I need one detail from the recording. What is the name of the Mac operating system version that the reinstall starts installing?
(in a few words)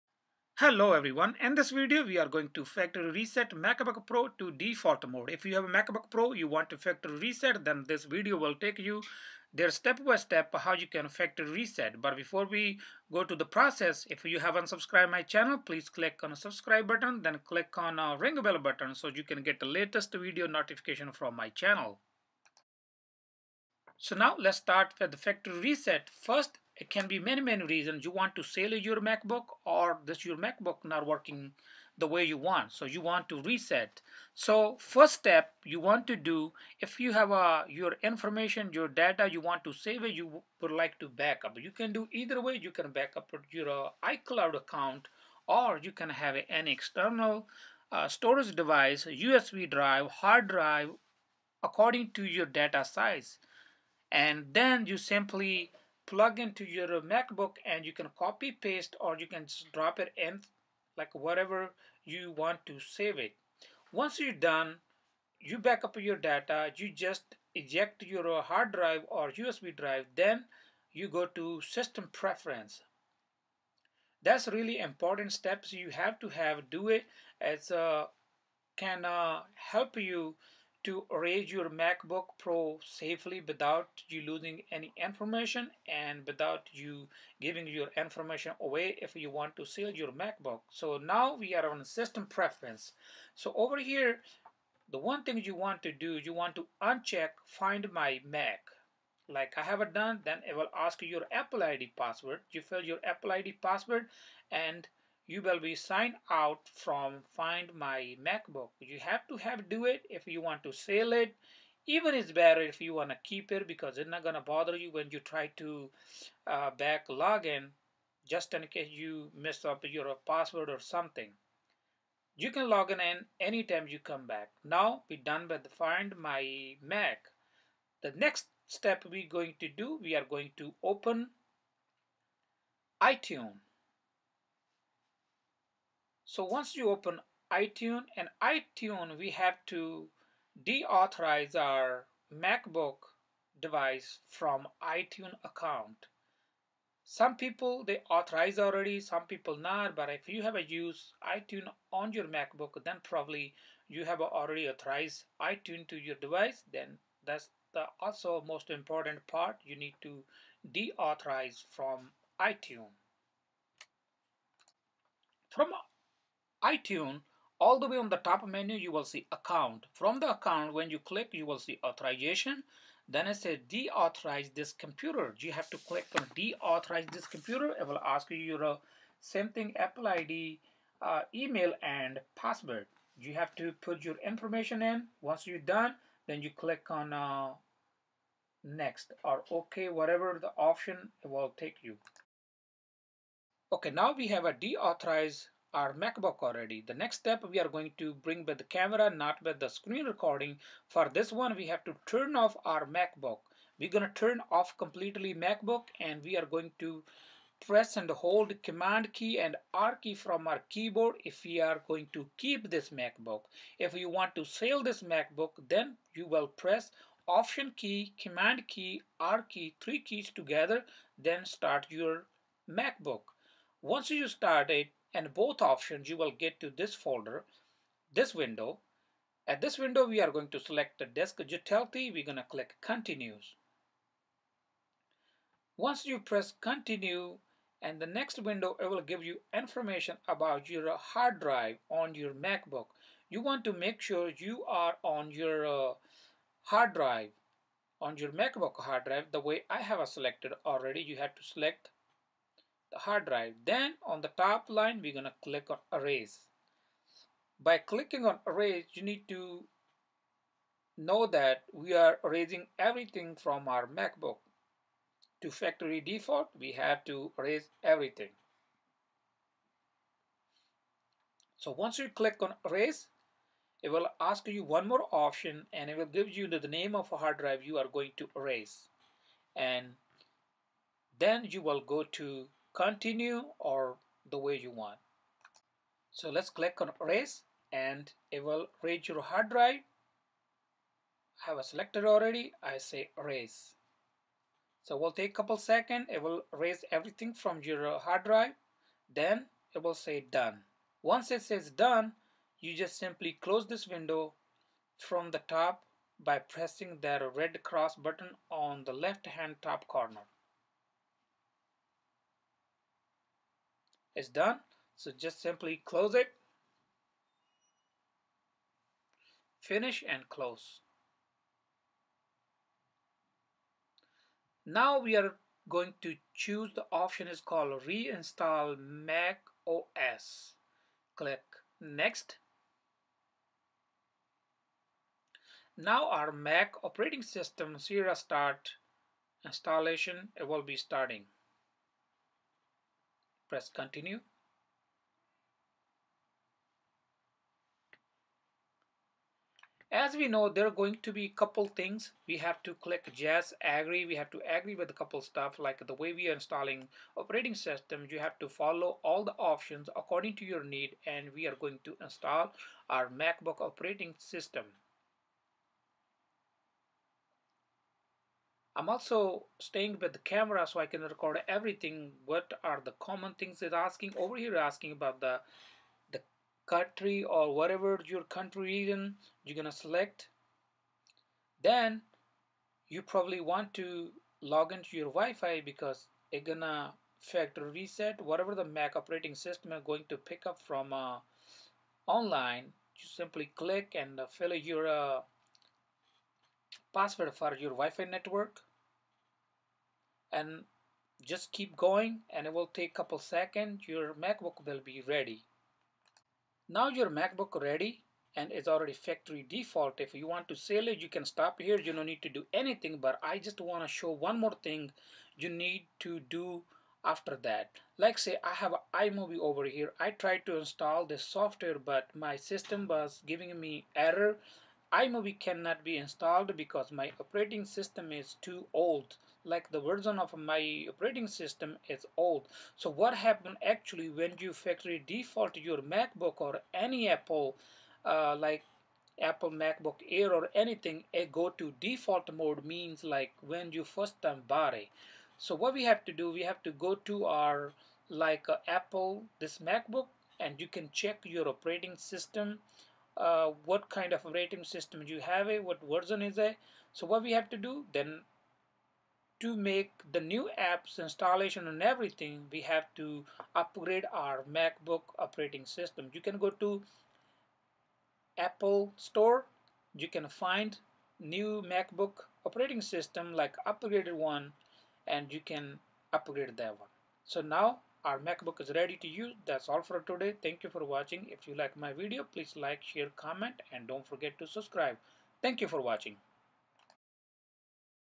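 Sierra.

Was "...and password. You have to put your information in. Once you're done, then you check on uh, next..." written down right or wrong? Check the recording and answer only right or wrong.
wrong.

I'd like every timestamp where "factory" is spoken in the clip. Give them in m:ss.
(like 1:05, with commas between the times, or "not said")
0:02, 0:06, 0:11, 0:25, 4:25, 6:27, 6:48, 7:14.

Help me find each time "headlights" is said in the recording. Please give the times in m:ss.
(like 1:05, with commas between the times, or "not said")
not said.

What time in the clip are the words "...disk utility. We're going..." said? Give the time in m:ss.
3:51.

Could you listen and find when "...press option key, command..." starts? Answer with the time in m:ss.
3:36.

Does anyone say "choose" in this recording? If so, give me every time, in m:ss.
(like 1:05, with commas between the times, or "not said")
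5:26.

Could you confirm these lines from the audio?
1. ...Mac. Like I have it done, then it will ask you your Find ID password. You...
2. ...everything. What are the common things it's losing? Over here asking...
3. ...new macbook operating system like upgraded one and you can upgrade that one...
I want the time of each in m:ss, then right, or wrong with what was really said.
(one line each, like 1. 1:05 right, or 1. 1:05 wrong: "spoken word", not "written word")
1. 1:38 wrong: "Apple", not "Find"
2. 6:11 wrong: "asking", not "losing"
3. 7:51 right.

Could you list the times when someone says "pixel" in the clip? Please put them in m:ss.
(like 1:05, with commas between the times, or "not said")
not said.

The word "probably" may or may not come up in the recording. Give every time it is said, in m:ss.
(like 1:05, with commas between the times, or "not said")
2:33, 6:23.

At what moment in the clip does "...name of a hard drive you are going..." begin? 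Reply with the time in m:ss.
4:36.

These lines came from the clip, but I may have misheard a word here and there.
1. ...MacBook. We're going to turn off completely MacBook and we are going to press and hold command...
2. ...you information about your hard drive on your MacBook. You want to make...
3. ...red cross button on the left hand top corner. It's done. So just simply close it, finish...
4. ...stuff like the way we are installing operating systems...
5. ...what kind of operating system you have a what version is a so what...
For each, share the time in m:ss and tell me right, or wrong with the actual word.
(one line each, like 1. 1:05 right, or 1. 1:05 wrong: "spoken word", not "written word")
1. 3:22 right
2. 3:59 right
3. 5:07 right
4. 5:55 right
5. 7:33 right.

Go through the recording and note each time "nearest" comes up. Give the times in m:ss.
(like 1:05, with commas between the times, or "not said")
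not said.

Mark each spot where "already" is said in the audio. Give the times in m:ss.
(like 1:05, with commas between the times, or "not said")
2:28, 2:34, 3:16, 4:10, 4:52, 6:48.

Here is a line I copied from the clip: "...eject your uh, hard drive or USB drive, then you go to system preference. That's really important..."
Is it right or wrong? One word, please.
right.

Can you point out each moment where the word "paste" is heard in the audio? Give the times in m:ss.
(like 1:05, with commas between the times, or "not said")
0:58.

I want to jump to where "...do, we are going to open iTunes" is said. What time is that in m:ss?
2:09.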